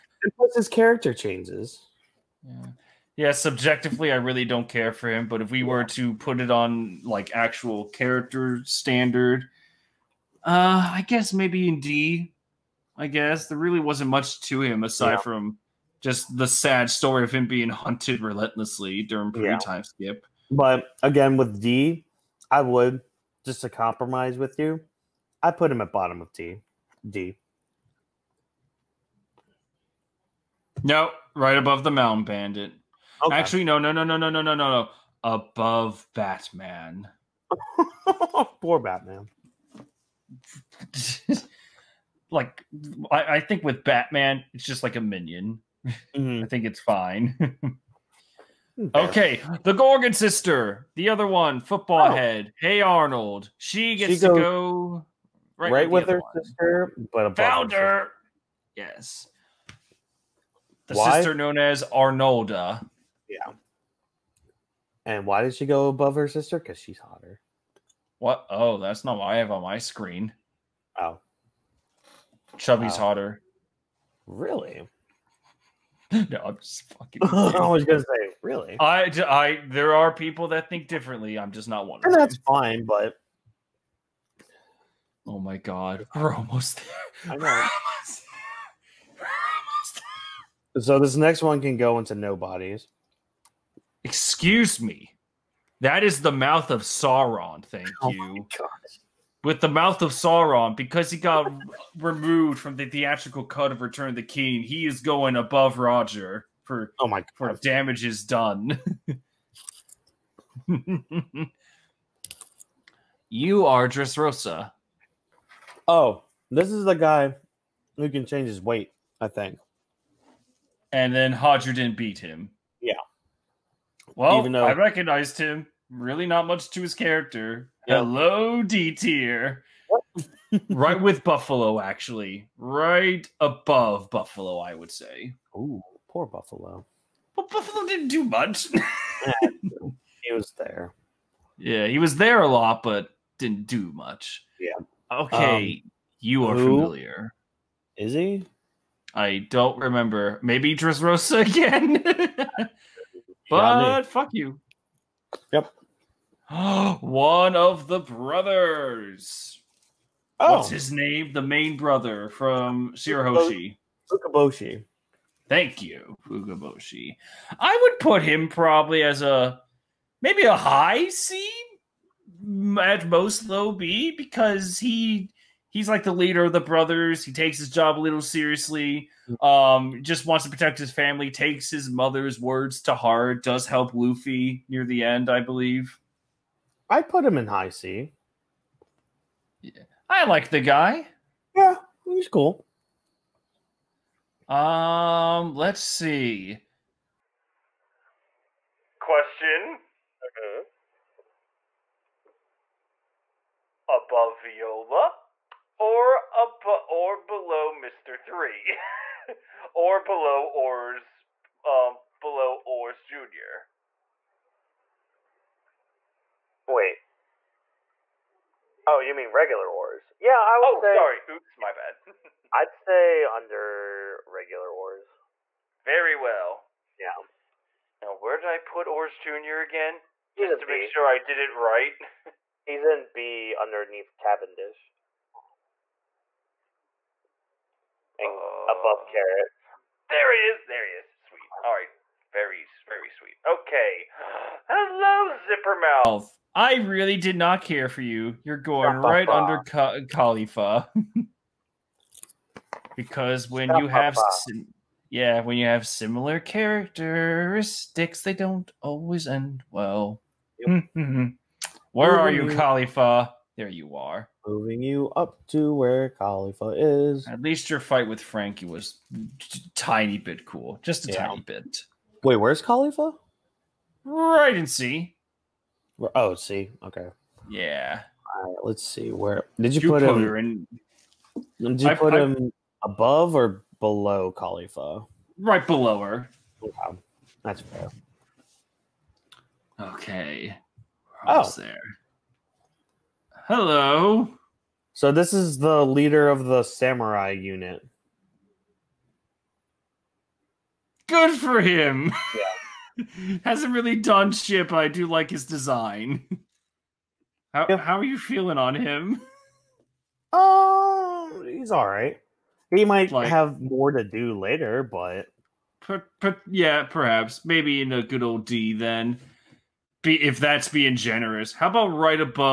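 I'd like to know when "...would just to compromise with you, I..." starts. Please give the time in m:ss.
0:22.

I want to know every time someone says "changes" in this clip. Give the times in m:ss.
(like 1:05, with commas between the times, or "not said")
0:01, 1:58.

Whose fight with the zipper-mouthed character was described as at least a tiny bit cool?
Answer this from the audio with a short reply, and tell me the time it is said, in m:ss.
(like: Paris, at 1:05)
Franky, at 4:28.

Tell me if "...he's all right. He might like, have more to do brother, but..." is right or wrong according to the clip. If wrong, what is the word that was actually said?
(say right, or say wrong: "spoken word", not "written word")
wrong: "later", not "brother".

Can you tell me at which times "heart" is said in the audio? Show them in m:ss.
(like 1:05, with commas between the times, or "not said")
3:02.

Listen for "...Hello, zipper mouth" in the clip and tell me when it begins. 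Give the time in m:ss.
4:04.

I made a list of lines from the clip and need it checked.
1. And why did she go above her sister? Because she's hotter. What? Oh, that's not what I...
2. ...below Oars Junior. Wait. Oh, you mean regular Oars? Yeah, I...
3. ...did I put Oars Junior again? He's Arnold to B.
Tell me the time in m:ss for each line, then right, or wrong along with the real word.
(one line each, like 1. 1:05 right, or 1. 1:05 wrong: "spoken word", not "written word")
1. 1:05 right
2. 3:32 right
3. 3:48 wrong: "Just", not "Arnold".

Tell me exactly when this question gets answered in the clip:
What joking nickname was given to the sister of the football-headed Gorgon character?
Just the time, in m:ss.
1:01.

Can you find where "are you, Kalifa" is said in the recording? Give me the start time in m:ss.
4:22.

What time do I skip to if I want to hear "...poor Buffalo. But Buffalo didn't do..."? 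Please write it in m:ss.
2:16.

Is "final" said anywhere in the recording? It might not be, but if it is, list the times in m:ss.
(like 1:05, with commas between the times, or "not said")
not said.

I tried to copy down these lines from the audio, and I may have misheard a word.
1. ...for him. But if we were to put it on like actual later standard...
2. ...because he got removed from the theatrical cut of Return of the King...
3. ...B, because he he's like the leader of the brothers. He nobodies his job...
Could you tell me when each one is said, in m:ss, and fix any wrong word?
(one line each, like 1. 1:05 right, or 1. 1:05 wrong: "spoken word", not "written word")
1. 0:04 wrong: "character", not "later"
2. 1:40 right
3. 2:53 wrong: "takes", not "nobodies".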